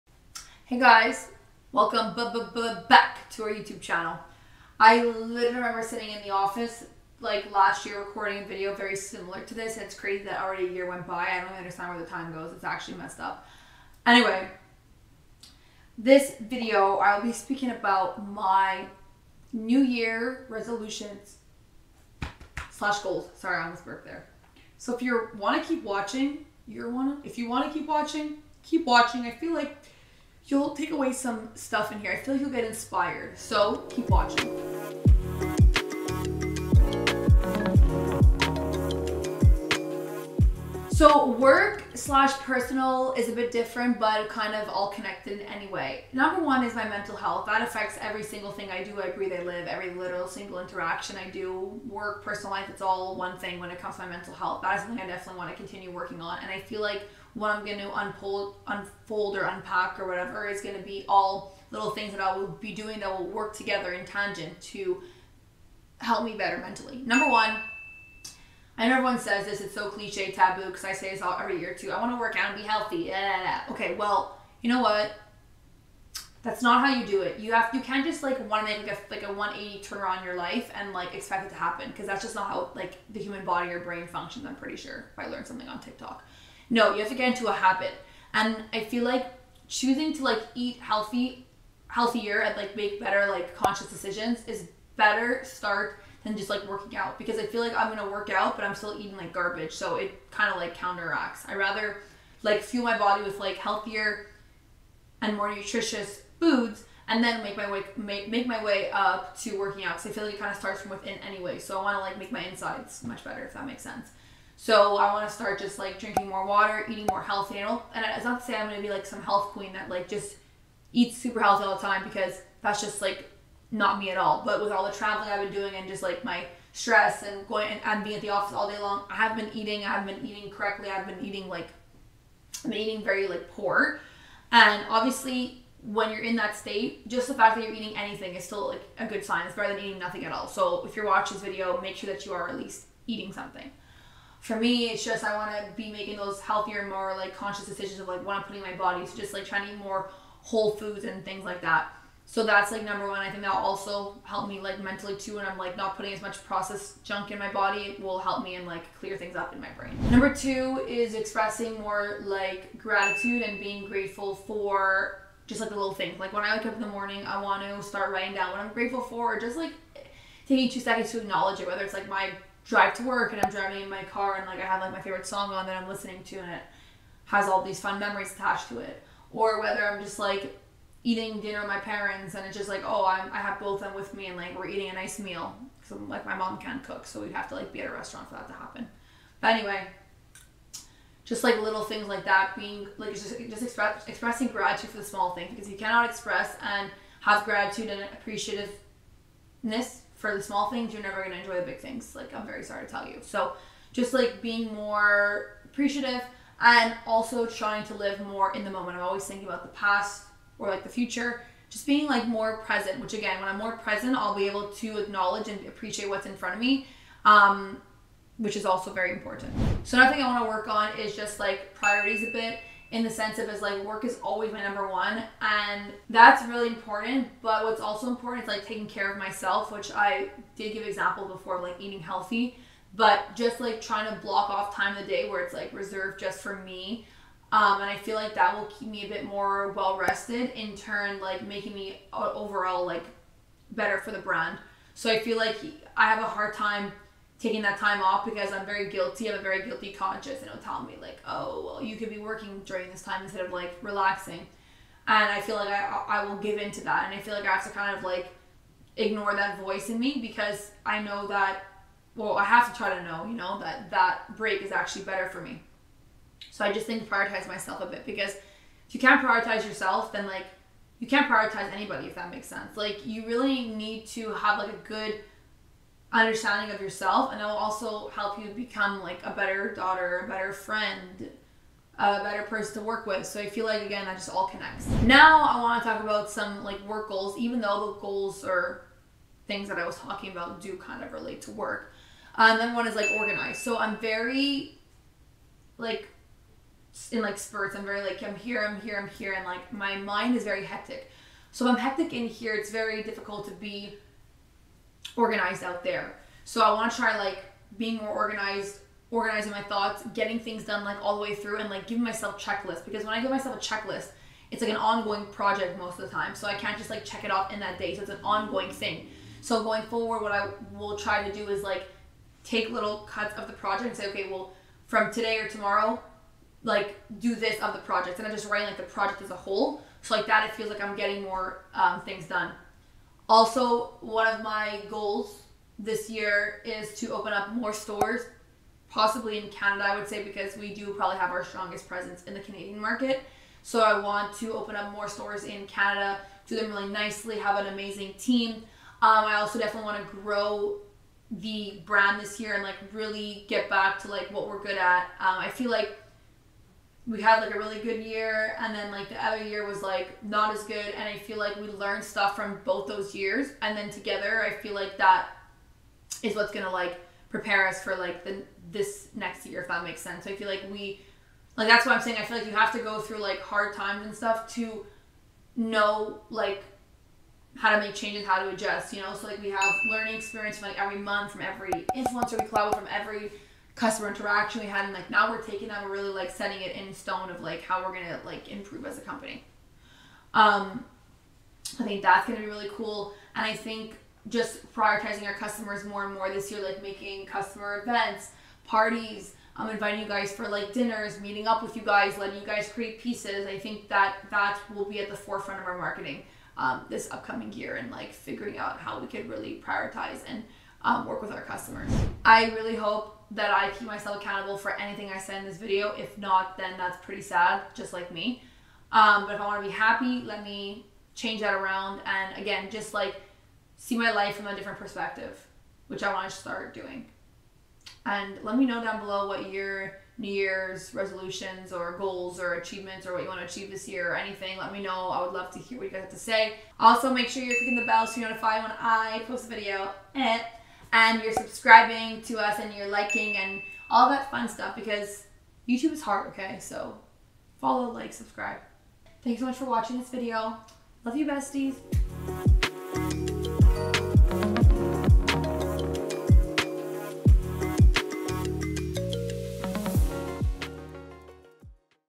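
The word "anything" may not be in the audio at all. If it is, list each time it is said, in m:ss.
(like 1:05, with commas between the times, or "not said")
2:17, 6:54, 7:14.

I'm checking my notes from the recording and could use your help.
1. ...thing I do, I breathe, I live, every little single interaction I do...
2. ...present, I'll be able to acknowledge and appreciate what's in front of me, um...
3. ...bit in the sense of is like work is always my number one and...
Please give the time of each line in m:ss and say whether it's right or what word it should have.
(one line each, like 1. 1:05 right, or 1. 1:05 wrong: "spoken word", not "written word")
1. 0:48 right
2. 3:33 right
3. 3:42 right.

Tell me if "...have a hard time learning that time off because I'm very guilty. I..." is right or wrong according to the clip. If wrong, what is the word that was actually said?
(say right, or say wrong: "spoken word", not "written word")
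wrong: "taking", not "learning".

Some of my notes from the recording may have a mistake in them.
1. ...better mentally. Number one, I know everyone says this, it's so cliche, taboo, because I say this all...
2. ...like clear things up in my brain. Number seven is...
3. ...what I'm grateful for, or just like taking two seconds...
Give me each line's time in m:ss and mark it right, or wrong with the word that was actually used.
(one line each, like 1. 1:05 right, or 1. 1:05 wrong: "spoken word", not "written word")
1. 1:06 right
2. 2:38 wrong: "two", not "seven"
3. 2:48 right.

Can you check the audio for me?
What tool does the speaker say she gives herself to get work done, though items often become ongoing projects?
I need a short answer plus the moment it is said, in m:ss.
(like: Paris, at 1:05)
Checklists, at 5:12.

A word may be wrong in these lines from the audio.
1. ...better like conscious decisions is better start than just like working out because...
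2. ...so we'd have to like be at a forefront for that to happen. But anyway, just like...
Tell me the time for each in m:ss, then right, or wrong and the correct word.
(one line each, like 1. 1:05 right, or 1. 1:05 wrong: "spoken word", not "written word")
1. 1:32 right
2. 3:07 wrong: "restaurant", not "forefront".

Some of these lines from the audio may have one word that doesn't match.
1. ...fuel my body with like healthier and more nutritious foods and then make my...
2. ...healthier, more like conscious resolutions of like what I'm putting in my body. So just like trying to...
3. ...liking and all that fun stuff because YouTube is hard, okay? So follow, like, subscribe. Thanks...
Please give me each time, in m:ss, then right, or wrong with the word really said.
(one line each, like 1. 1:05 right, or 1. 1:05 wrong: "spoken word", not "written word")
1. 1:42 right
2. 2:26 wrong: "decisions", not "resolutions"
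3. 7:22 right.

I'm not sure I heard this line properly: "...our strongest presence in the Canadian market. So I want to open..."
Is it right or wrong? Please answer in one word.
right.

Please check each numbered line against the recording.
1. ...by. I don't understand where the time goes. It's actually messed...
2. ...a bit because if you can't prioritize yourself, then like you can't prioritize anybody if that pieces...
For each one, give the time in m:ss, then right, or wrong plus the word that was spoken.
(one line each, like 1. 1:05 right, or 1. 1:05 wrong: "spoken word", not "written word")
1. 0:11 right
2. 4:27 wrong: "makes", not "pieces".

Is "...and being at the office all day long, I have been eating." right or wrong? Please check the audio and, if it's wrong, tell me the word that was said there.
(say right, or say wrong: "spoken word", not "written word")
right.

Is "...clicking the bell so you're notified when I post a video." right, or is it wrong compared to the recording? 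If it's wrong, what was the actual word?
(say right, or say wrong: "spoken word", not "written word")
right.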